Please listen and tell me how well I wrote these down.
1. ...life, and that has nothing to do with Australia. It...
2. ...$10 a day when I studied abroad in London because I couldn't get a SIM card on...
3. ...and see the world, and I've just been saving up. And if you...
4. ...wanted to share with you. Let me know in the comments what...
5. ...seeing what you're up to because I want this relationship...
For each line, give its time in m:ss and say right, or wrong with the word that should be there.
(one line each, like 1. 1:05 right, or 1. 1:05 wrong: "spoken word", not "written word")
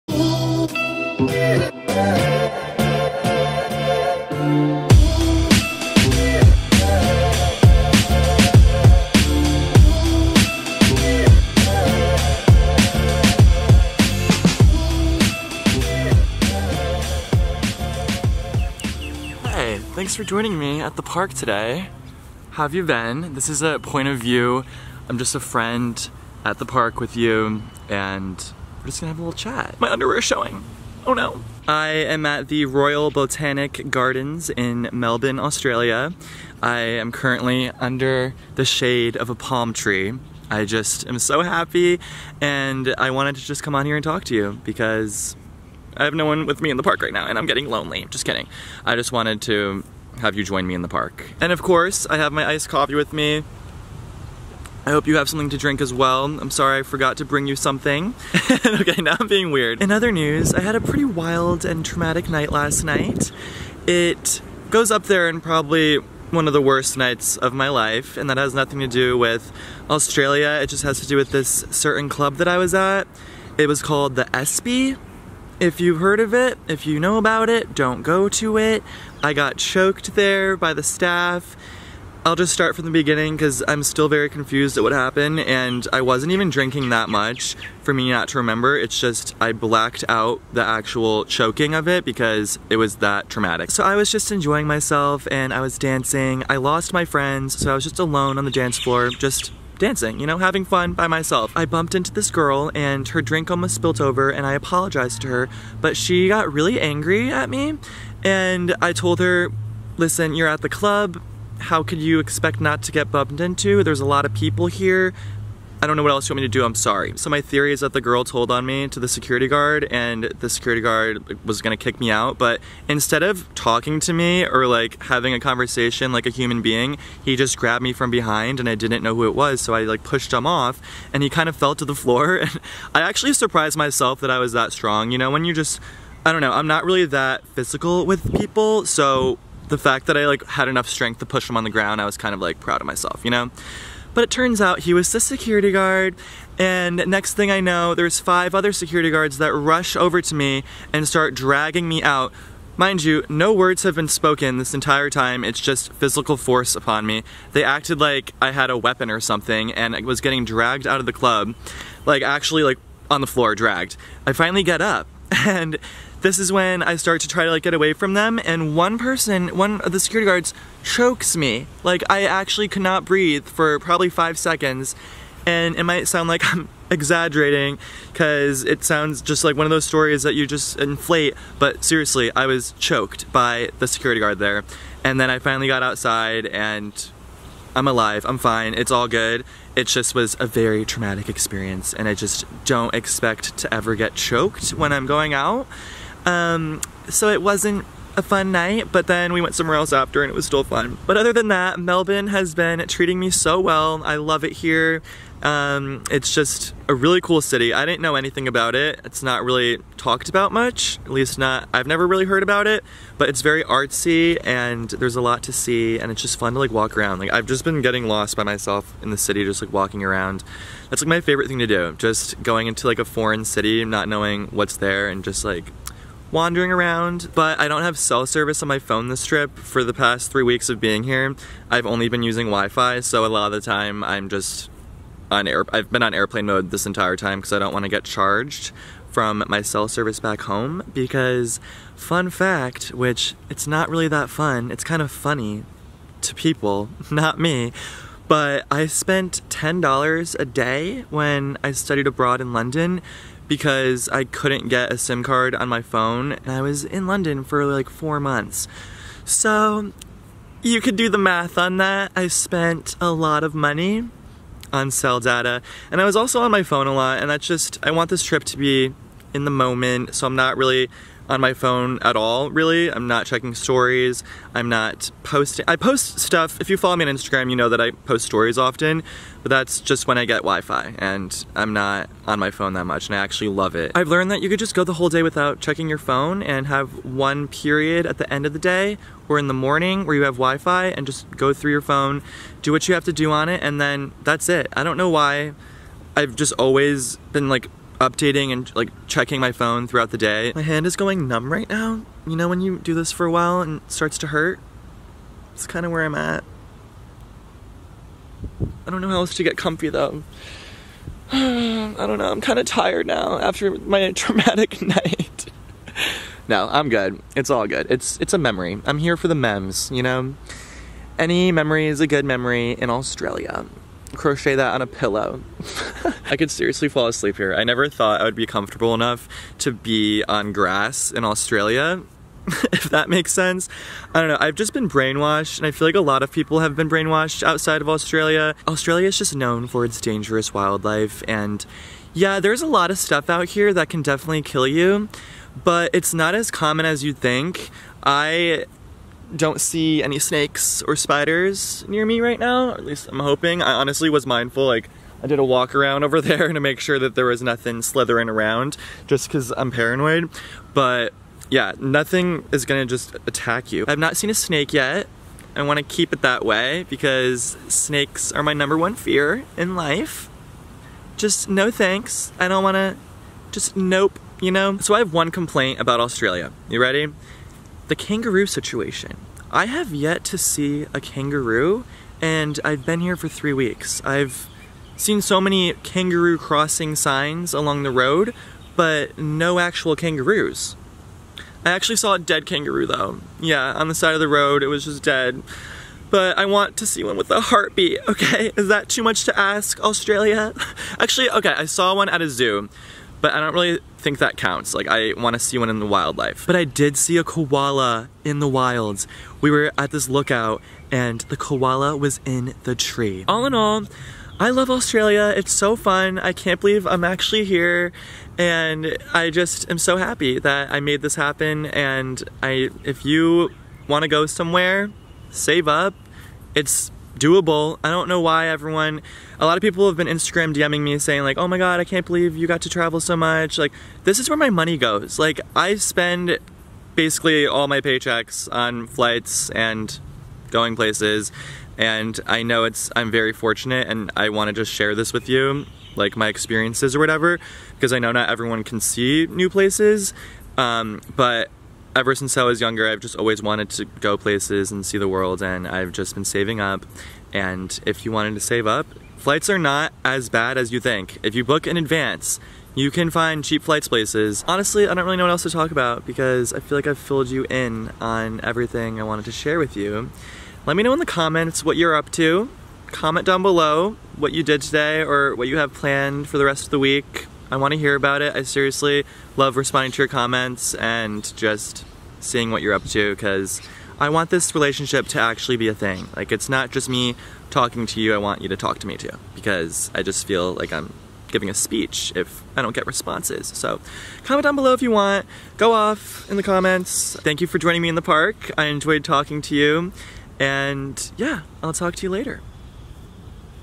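1. 1:07 right
2. 4:09 right
3. 7:34 right
4. 7:49 right
5. 8:02 right.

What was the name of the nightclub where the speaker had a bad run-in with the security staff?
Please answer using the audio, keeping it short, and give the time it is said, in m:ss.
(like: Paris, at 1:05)
The Espy, at 1:14.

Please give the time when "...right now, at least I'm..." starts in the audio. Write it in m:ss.
5:52.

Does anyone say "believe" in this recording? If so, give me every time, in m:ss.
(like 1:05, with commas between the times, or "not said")
6:56, 7:12.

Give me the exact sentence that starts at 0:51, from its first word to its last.
And of course, I have my iced coffee with me I hope you have something to drink as well.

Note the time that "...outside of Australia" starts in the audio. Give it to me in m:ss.
5:37.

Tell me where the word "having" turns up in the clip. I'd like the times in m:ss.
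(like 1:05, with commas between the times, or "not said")
1:40, 2:05.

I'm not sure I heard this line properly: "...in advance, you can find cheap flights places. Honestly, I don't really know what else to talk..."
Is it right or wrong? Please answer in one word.
right.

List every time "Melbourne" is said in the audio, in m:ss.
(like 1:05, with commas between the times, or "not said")
0:34, 3:21.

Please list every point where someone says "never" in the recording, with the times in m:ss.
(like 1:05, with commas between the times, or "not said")
3:31, 5:27.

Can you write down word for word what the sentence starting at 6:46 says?
But I did see a koala in the wilds.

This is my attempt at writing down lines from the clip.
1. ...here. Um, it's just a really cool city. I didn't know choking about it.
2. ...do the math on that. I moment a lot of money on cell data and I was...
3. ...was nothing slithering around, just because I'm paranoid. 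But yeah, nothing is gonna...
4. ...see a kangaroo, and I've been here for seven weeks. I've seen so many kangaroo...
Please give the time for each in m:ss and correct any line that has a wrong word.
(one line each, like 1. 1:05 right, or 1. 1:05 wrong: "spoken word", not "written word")
1. 3:24 wrong: "anything", not "choking"
2. 4:20 wrong: "spent", not "moment"
3. 5:57 right
4. 6:20 wrong: "three", not "seven".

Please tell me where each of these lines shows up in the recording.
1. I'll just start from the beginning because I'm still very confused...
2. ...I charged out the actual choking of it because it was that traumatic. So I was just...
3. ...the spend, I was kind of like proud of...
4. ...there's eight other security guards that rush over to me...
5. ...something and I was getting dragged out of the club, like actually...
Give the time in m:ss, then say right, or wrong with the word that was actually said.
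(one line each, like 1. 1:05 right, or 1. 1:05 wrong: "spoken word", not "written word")
1. 1:22 right
2. 1:29 wrong: "blacked", not "charged"
3. 2:21 wrong: "ground", not "spend"
4. 2:27 wrong: "five", not "eight"
5. 2:39 right.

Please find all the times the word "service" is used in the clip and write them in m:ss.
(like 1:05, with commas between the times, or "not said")
3:48, 3:59.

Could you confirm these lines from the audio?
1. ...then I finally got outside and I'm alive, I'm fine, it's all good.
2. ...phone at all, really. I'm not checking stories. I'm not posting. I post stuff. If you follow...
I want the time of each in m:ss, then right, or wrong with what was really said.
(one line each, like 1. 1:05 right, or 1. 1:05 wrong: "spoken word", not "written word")
1. 3:05 right
2. 4:31 right.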